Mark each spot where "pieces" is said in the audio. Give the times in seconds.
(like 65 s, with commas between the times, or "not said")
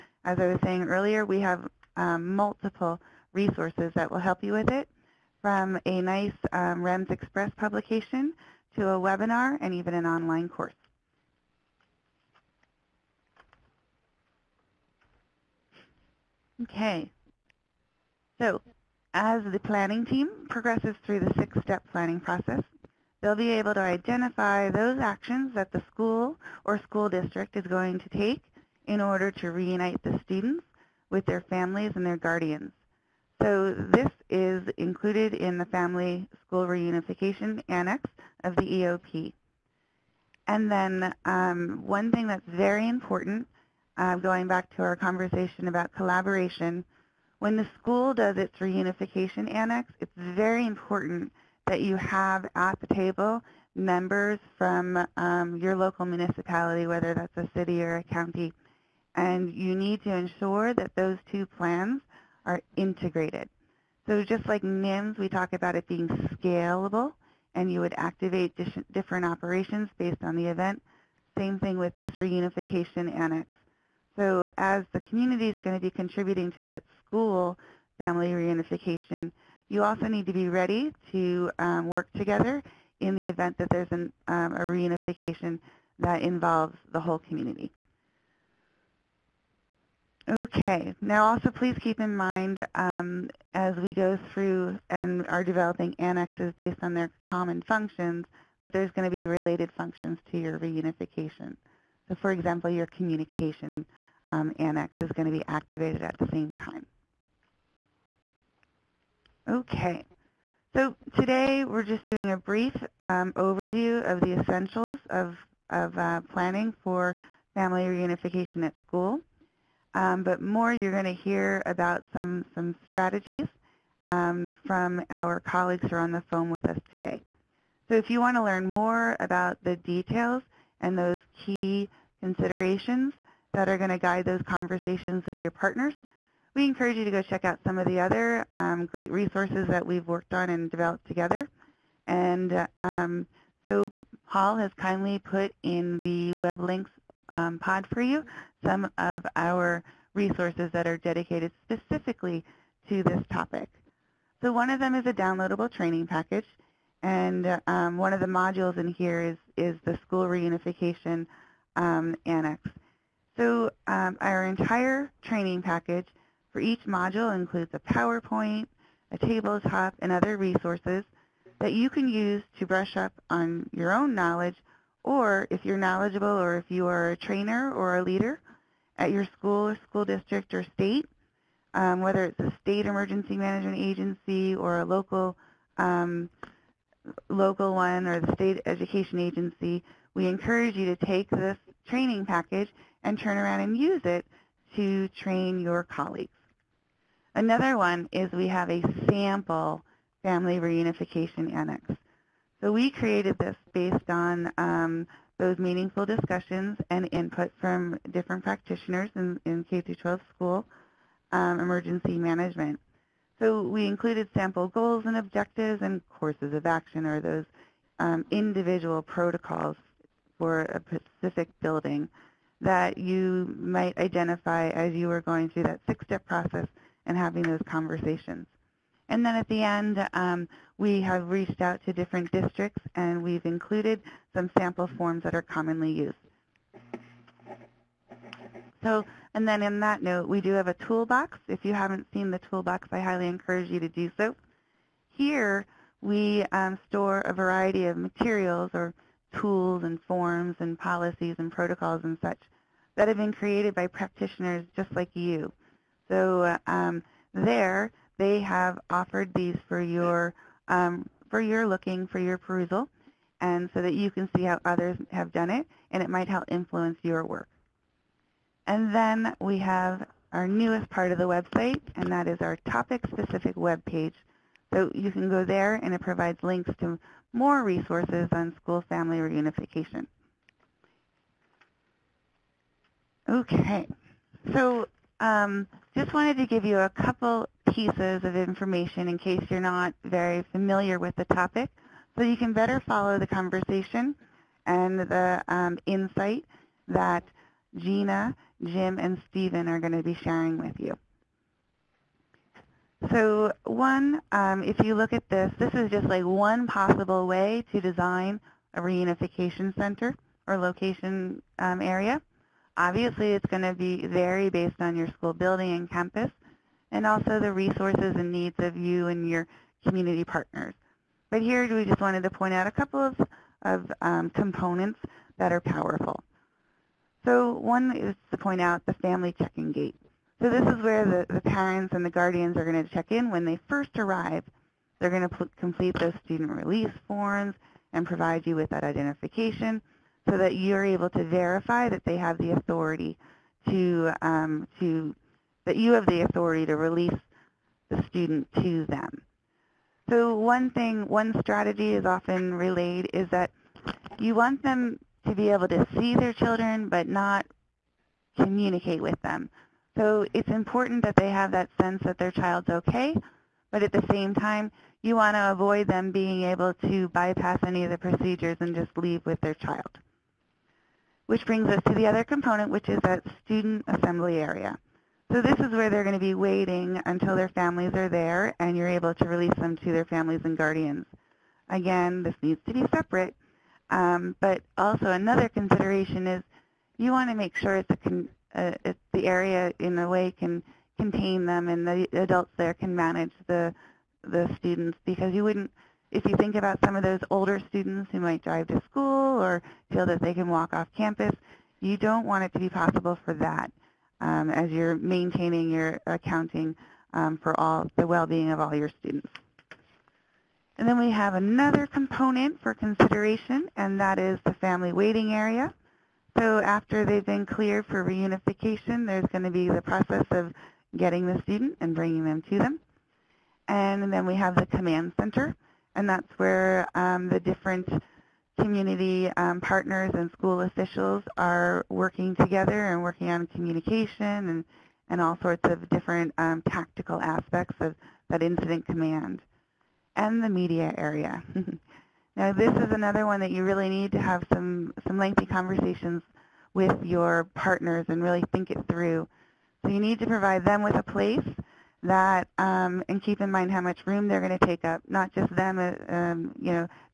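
287 s.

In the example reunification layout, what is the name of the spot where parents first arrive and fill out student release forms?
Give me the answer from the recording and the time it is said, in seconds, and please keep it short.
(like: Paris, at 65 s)
Family check-in gate, at 328 s.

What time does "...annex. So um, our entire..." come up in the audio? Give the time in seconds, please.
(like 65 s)
162 s.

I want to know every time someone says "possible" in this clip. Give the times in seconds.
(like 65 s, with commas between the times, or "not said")
306 s, 402 s.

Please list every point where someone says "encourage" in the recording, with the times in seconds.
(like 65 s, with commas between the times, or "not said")
136 s, 190 s, 243 s.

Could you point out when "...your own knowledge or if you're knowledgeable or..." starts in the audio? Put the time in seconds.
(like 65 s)
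173 s.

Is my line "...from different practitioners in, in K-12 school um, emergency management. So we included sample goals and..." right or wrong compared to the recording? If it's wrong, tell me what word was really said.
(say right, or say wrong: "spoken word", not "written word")
right.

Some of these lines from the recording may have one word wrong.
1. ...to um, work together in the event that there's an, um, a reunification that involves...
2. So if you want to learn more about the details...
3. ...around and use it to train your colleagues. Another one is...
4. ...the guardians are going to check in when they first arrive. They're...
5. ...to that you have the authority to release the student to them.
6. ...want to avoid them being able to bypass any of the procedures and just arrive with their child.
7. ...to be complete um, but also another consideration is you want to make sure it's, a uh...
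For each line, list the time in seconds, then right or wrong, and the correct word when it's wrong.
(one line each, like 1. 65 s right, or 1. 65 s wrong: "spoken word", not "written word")
1. 81 s right
2. 127 s right
3. 193 s right
4. 332 s right
5. 344 s right
6. 365 s wrong: "leave", not "arrive"
7. 382 s wrong: "separate", not "complete".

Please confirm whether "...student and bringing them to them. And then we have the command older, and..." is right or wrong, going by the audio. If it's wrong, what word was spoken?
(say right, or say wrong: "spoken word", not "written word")
wrong: "center", not "older".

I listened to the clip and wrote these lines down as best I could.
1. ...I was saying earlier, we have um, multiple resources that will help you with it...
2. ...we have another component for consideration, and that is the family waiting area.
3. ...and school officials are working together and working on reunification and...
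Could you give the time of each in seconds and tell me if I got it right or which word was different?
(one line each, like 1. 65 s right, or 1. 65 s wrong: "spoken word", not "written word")
1. 0 s right
2. 410 s right
3. 430 s wrong: "communication", not "reunification".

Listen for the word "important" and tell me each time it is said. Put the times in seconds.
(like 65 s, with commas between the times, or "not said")
42 s, 50 s, 360 s.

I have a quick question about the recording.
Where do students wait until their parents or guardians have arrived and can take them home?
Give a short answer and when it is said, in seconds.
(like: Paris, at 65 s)
Student assembly area, at 373 s.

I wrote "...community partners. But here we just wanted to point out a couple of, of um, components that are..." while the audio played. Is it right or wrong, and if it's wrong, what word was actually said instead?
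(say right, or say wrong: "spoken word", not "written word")
right.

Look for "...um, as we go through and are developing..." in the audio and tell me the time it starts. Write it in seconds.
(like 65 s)
92 s.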